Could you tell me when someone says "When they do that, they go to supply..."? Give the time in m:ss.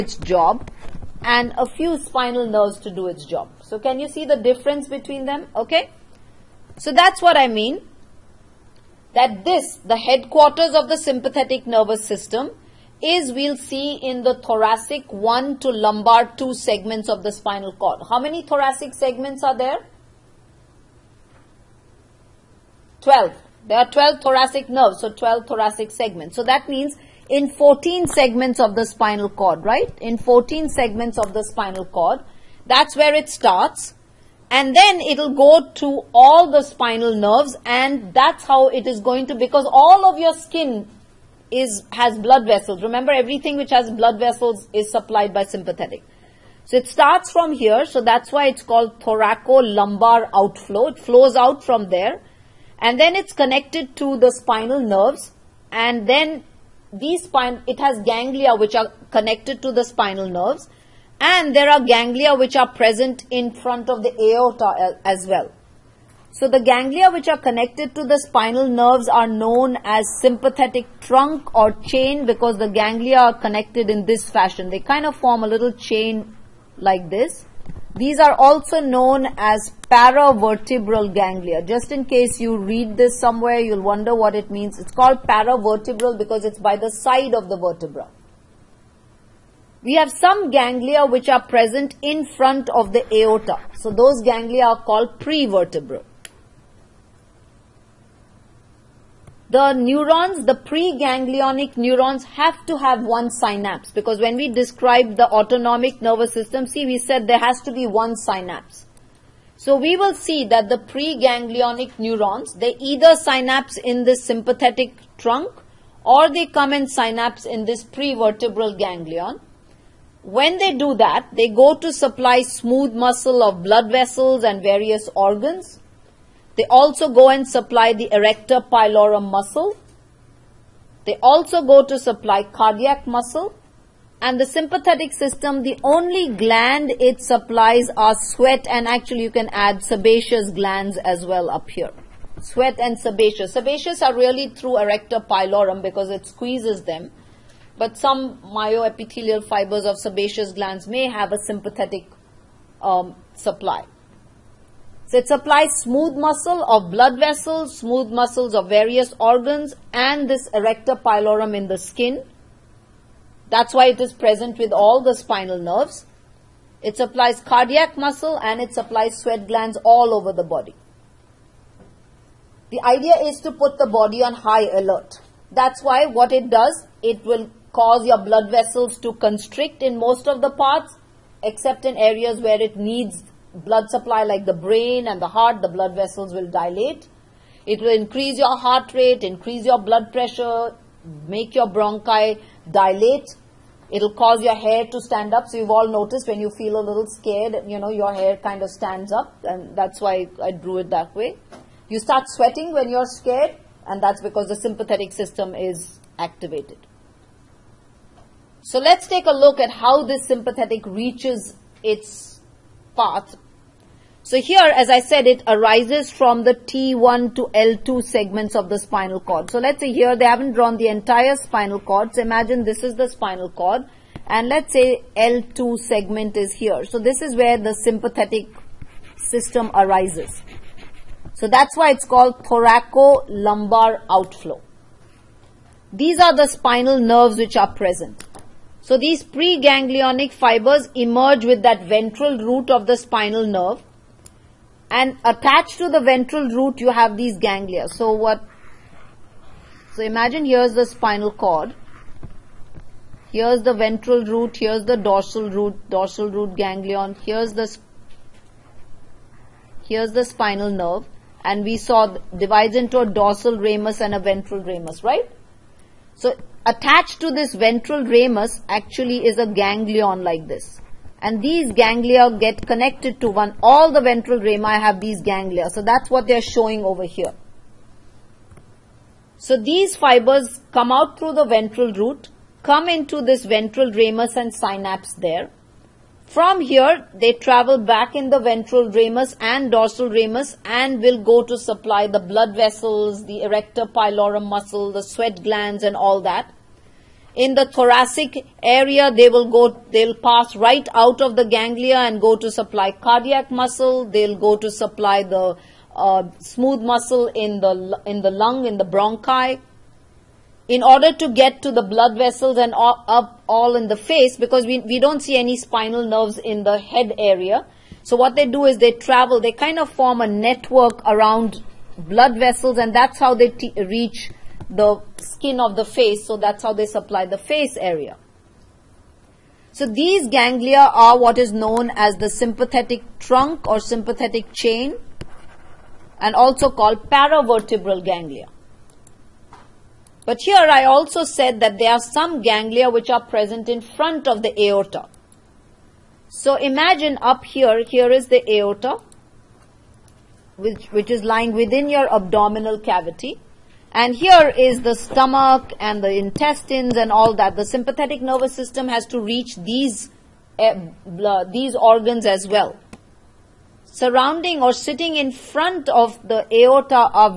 2:00.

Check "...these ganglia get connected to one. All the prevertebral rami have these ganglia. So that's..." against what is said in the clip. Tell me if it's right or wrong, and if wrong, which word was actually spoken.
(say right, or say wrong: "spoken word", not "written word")
wrong: "ventral", not "prevertebral".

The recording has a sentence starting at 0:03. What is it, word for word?
So can you see the difference between them?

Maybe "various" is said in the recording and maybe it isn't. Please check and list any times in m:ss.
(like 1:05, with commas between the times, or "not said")
2:04, 2:38.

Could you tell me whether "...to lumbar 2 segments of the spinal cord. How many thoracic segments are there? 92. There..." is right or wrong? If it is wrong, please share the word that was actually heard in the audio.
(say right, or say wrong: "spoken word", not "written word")
wrong: "12", not "92".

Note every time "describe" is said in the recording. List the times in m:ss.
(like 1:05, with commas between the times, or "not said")
1:44.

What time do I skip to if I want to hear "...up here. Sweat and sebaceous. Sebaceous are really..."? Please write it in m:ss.
2:21.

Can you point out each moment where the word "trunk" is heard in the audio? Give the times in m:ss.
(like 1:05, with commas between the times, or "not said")
1:11, 1:55, 5:33.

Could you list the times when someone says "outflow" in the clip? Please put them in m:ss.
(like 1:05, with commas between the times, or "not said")
0:50, 3:54.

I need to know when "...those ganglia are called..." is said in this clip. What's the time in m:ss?
1:33.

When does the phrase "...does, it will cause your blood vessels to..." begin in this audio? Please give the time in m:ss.
2:56.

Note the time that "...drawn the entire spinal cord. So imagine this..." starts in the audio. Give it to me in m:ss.
3:40.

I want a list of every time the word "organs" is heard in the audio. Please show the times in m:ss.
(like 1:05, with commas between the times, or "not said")
2:05, 2:39, 6:01.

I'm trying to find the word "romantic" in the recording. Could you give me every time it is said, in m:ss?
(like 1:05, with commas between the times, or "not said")
not said.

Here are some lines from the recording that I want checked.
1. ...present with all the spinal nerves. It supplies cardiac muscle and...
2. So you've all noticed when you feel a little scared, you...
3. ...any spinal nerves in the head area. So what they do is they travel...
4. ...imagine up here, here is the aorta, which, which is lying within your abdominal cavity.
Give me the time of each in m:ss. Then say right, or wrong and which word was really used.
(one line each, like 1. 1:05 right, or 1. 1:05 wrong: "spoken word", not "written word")
1. 2:44 right
2. 3:15 right
3. 5:15 right
4. 5:46 right.